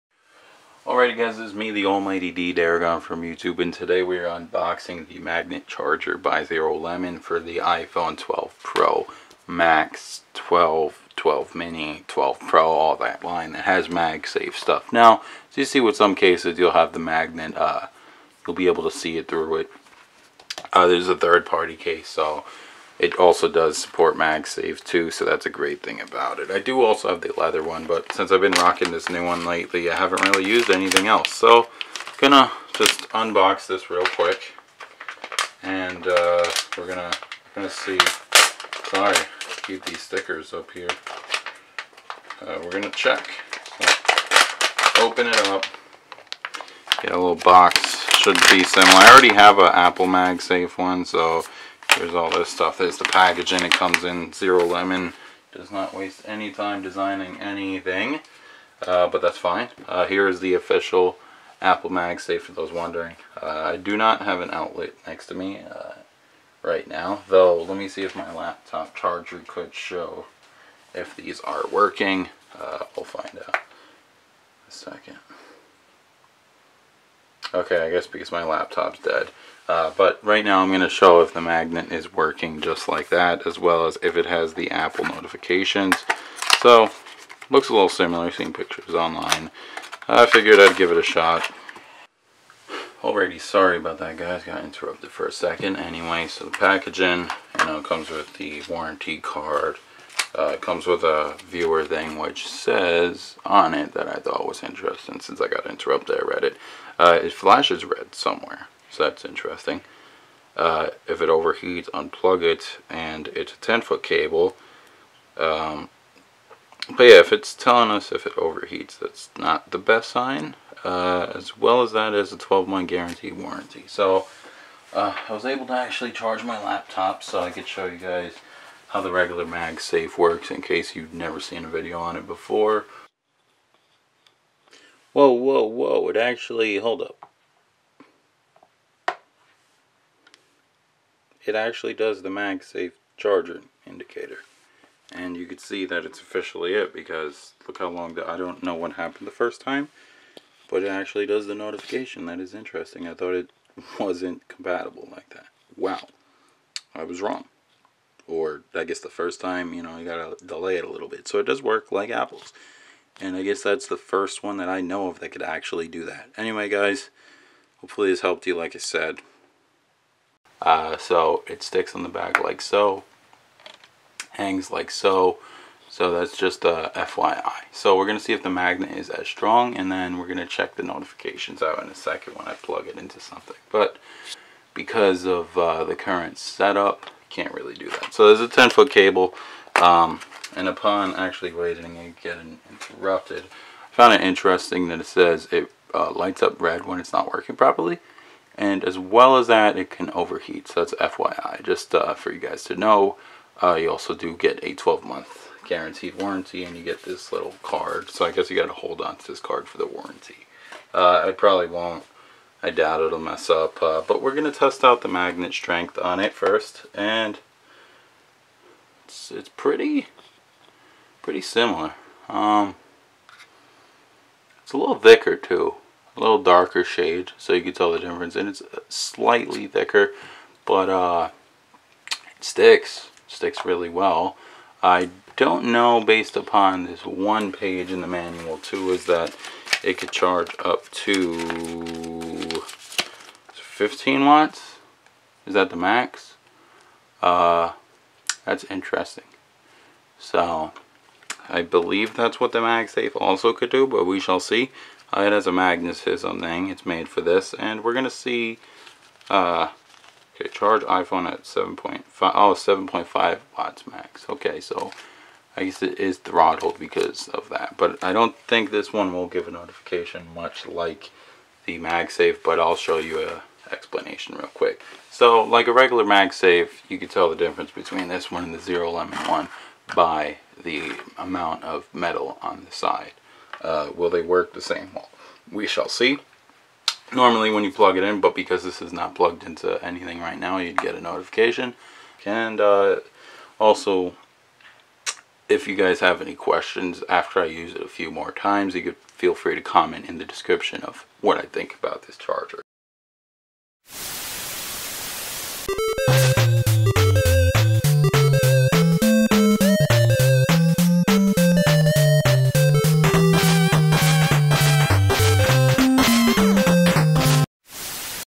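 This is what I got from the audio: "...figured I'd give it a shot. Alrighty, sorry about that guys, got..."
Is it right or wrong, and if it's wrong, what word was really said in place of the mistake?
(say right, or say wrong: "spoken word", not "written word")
right.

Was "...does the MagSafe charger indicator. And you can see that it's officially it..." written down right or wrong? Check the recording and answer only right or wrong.
right.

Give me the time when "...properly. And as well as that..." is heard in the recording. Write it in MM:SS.
03:17.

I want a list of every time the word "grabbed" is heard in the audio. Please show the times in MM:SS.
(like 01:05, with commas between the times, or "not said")
not said.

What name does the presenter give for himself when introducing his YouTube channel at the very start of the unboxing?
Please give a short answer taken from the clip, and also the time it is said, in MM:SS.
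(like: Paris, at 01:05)
D Darigon, at 00:02.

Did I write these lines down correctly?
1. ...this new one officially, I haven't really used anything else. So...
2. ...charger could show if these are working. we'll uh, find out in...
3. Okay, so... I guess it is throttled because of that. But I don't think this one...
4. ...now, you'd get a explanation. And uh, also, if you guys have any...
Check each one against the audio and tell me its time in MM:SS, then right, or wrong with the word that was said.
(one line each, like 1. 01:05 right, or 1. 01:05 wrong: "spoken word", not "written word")
1. 00:28 wrong: "lately", not "officially"
2. 01:08 right
3. 04:24 right
4. 04:50 wrong: "notification", not "explanation".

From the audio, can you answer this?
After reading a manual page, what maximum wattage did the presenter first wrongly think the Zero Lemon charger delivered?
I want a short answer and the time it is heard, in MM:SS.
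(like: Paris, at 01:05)
15 watts, at 04:03.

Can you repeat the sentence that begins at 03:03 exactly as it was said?
But because of uh, the current setup, can't really do that.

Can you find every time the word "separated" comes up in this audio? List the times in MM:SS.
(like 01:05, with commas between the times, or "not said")
not said.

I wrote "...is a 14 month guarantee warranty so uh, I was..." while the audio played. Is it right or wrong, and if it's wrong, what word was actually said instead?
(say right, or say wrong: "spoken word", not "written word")
wrong: "12", not "14".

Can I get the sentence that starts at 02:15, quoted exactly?
Whoa, whoa, whoa, it actually, hold up.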